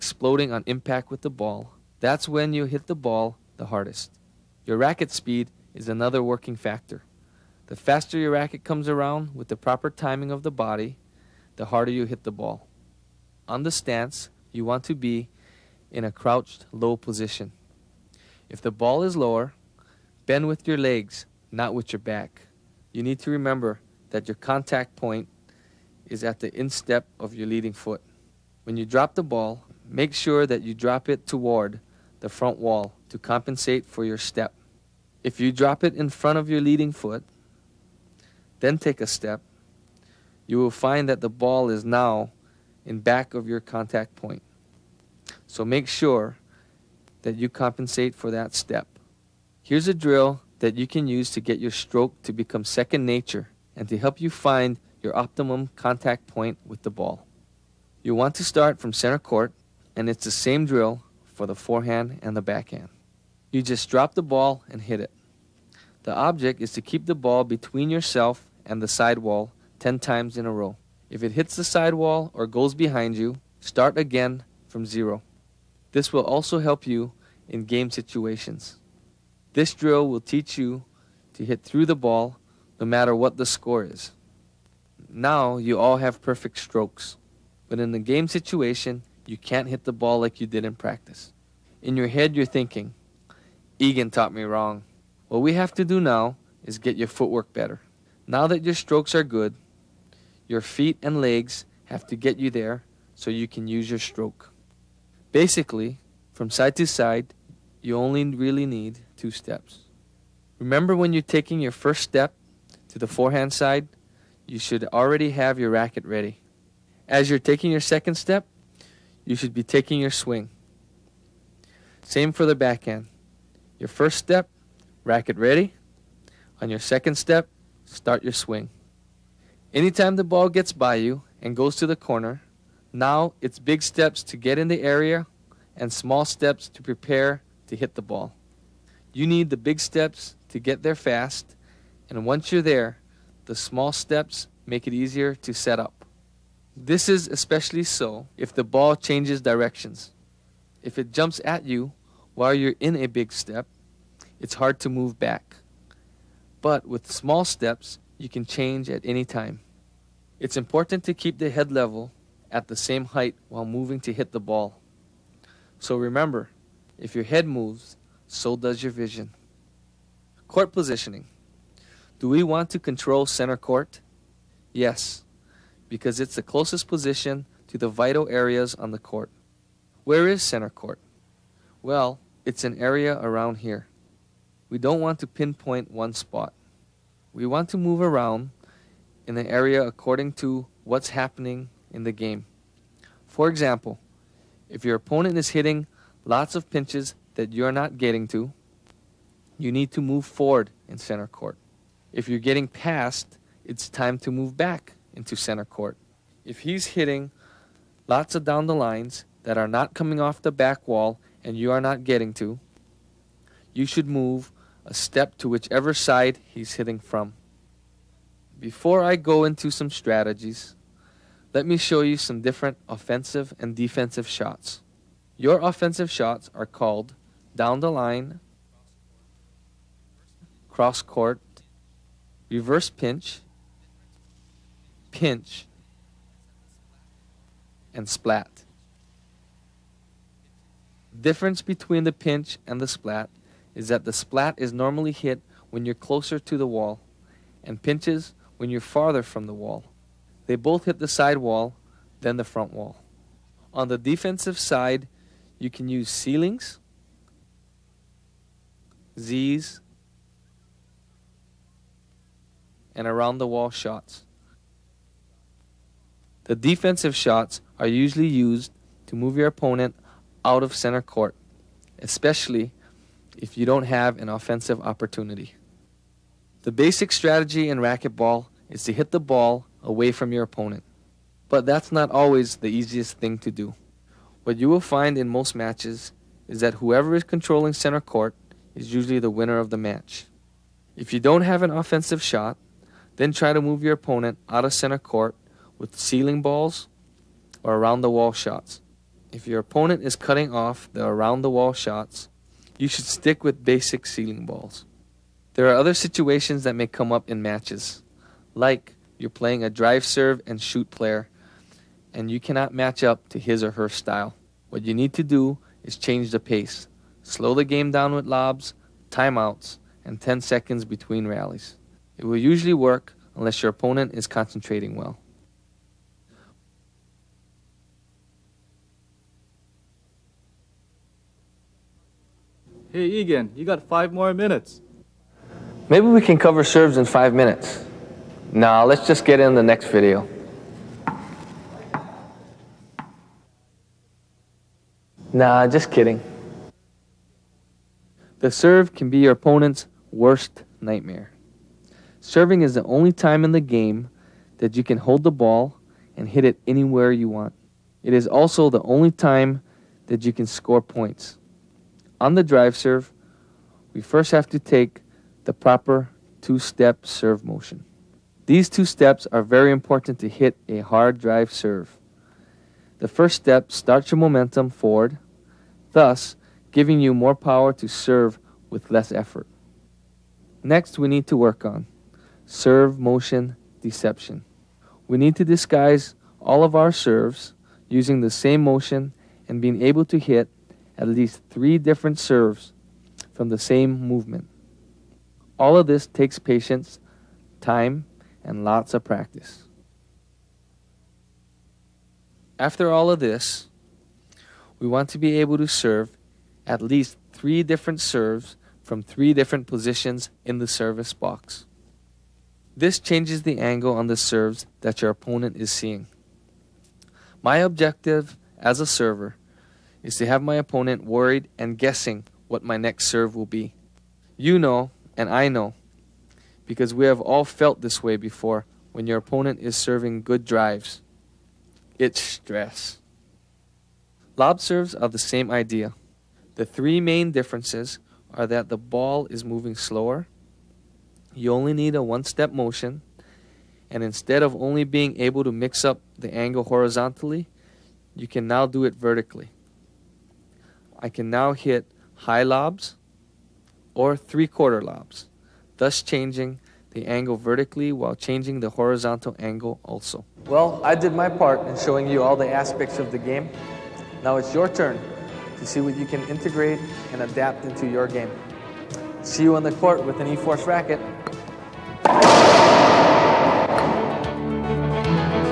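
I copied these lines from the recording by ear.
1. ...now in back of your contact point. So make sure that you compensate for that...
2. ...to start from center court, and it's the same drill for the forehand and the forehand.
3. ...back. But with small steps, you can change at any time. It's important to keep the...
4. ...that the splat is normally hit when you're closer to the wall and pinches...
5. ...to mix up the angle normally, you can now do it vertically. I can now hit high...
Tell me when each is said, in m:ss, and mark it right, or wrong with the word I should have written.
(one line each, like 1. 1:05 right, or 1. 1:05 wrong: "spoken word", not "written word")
1. 0:41 right
2. 0:58 wrong: "backhand", not "forehand"
3. 2:35 right
4. 4:03 right
5. 7:25 wrong: "horizontally", not "normally".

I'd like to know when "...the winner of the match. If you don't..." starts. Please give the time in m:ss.
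4:49.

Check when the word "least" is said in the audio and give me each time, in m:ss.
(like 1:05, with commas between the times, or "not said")
6:31, 6:46.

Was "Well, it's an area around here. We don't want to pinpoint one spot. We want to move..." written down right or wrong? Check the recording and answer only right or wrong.
right.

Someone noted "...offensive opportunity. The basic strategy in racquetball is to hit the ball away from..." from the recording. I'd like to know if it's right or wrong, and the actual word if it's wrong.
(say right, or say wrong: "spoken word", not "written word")
right.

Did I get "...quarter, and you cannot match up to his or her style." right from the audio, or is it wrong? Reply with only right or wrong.
wrong.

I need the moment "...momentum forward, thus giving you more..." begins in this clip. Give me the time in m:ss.
6:14.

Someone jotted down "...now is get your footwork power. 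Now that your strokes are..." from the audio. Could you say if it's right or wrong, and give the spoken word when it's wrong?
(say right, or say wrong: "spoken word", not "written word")
wrong: "better", not "power".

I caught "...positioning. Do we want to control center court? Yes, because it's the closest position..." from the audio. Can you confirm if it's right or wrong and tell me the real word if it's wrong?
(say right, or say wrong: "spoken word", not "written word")
right.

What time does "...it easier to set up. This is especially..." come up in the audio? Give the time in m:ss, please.
2:24.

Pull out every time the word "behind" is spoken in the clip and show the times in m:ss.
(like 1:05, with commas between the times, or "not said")
1:12.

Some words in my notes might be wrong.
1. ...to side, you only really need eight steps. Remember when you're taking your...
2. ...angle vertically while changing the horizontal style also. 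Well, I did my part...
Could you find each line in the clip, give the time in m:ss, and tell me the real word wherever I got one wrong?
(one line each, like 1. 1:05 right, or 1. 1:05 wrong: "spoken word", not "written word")
1. 1:46 wrong: "two", not "eight"
2. 7:37 wrong: "angle", not "style".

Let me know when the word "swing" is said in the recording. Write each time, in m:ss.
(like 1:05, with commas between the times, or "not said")
2:00, 2:08.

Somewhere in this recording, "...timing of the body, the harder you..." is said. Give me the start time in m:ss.
0:09.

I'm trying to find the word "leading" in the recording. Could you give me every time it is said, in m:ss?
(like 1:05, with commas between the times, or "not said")
0:27, 0:36.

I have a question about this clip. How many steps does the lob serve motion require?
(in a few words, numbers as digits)
1.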